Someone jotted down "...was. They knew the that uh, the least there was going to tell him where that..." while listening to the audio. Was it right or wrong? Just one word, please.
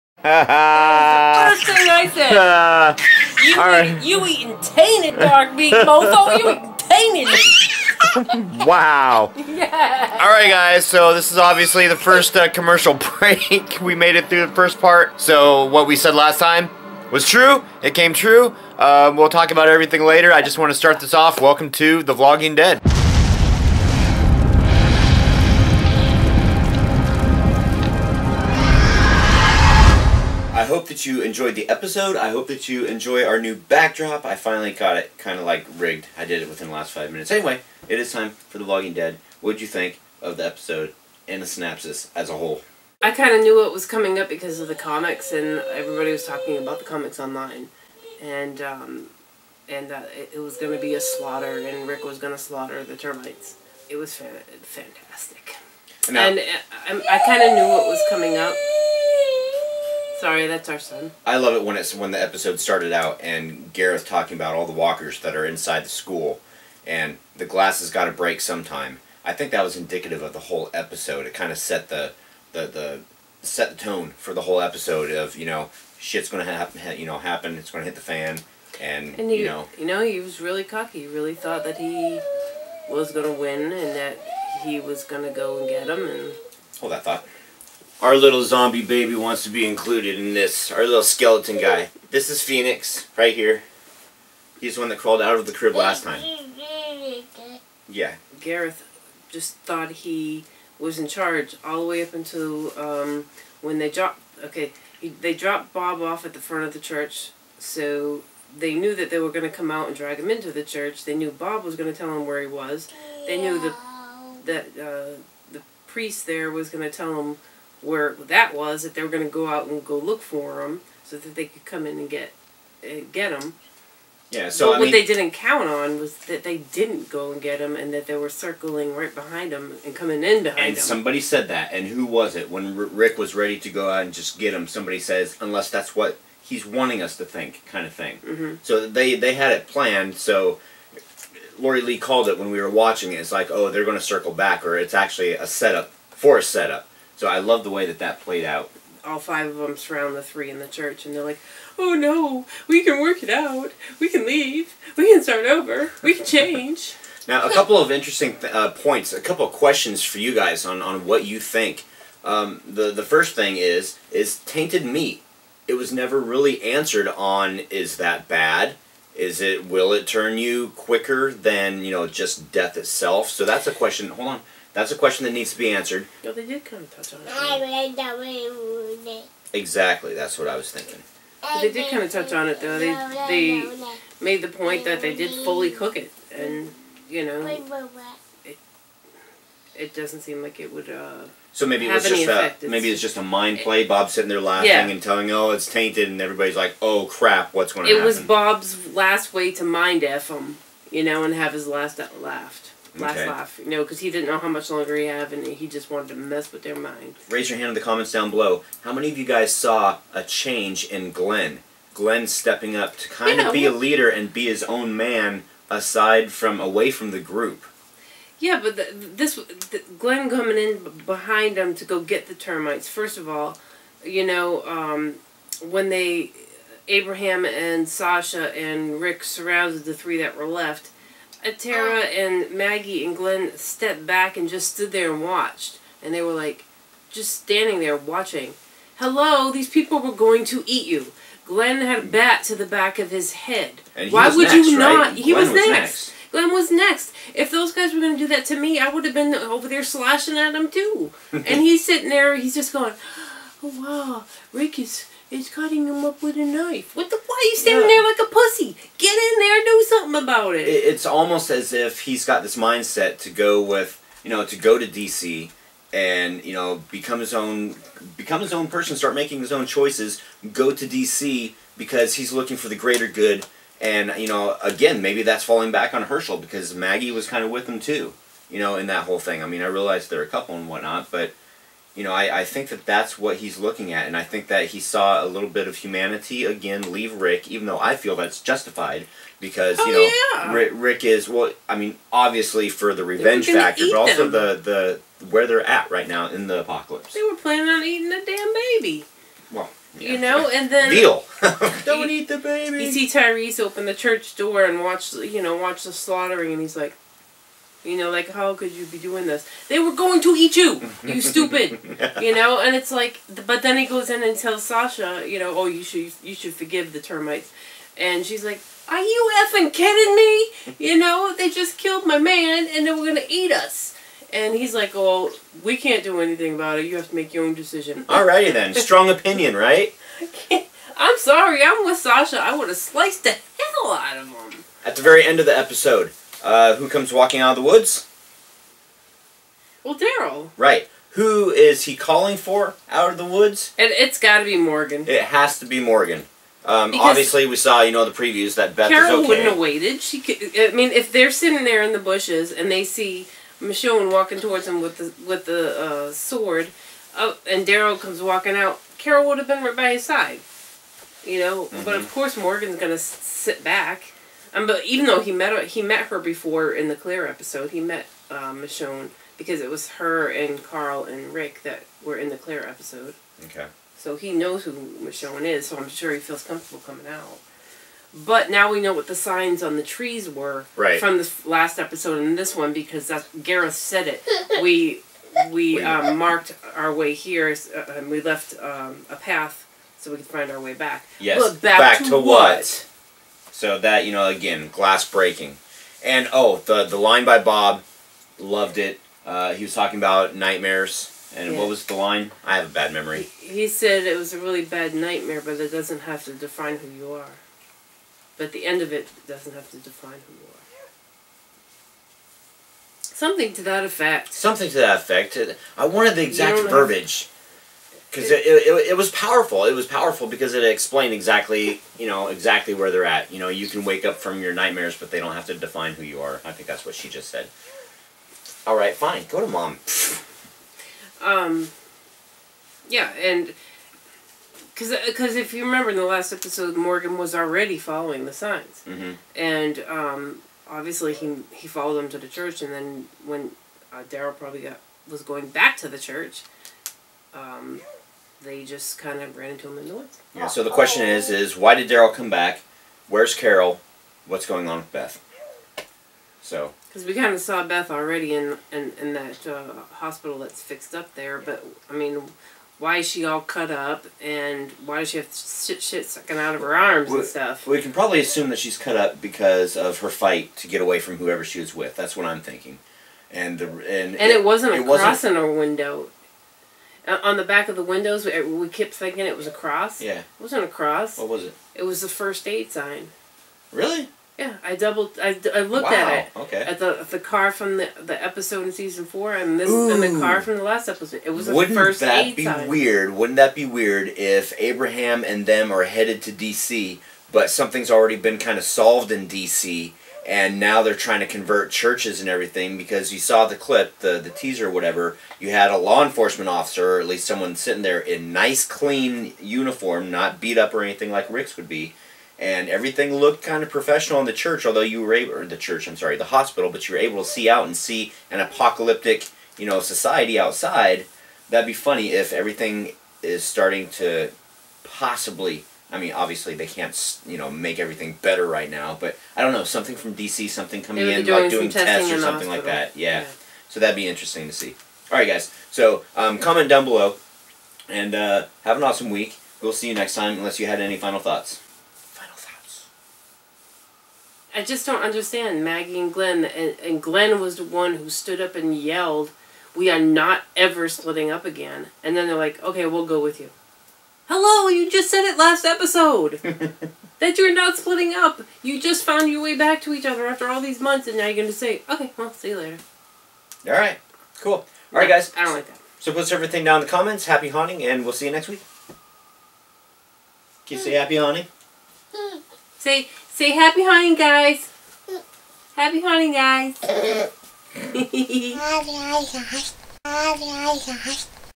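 wrong.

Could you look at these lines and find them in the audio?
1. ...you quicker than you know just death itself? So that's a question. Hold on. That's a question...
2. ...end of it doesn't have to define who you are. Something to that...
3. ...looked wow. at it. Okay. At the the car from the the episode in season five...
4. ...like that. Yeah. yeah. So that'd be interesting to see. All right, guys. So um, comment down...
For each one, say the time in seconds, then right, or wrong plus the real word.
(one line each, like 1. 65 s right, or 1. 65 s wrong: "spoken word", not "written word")
1. 170 s right
2. 408 s right
3. 485 s wrong: "four", not "five"
4. 532 s right.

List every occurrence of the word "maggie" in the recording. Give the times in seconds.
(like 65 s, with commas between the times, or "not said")
232 s, 276 s, 545 s.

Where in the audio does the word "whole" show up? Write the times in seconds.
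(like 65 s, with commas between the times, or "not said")
42 s, 70 s, 74 s, 279 s.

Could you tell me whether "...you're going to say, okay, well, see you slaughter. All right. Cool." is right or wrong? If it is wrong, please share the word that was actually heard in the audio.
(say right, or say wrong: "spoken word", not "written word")
wrong: "later", not "slaughter".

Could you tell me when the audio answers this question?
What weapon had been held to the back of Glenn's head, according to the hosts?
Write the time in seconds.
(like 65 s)
242 s.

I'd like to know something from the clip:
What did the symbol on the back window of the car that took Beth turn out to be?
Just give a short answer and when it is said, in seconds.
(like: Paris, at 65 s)
First aid sign, at 482 s.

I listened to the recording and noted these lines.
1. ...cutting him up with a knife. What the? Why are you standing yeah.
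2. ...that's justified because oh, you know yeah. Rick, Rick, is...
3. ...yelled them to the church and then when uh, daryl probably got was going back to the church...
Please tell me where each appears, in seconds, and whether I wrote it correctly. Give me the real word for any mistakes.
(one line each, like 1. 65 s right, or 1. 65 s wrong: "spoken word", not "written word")
1. 255 s right
2. 288 s right
3. 441 s wrong: "followed", not "yelled".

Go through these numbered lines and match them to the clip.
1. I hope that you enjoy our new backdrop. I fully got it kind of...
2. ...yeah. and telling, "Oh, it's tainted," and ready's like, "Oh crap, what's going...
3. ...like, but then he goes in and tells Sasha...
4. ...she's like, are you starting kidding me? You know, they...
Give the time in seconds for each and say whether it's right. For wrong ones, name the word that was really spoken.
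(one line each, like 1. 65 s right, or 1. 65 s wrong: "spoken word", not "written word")
1. 32 s wrong: "finally", not "fully"
2. 194 s wrong: "everybody", not "ready"
3. 312 s right
4. 318 s wrong: "effing", not "starting".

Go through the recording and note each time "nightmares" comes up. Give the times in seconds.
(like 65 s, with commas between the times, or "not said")
400 s, 404 s, 424 s.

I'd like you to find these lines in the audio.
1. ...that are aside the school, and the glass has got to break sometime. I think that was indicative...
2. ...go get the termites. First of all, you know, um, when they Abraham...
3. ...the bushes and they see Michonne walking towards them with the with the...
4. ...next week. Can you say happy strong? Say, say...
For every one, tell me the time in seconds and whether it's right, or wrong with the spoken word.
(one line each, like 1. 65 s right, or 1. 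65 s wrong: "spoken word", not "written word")
1. 65 s wrong: "inside", not "aside"
2. 221 s right
3. 351 s right
4. 568 s wrong: "haunting", not "strong".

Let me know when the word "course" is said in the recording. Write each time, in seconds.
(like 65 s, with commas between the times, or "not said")
362 s.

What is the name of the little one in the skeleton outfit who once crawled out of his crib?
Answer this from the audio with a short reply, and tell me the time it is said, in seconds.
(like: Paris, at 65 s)
Phoenix, at 92 s.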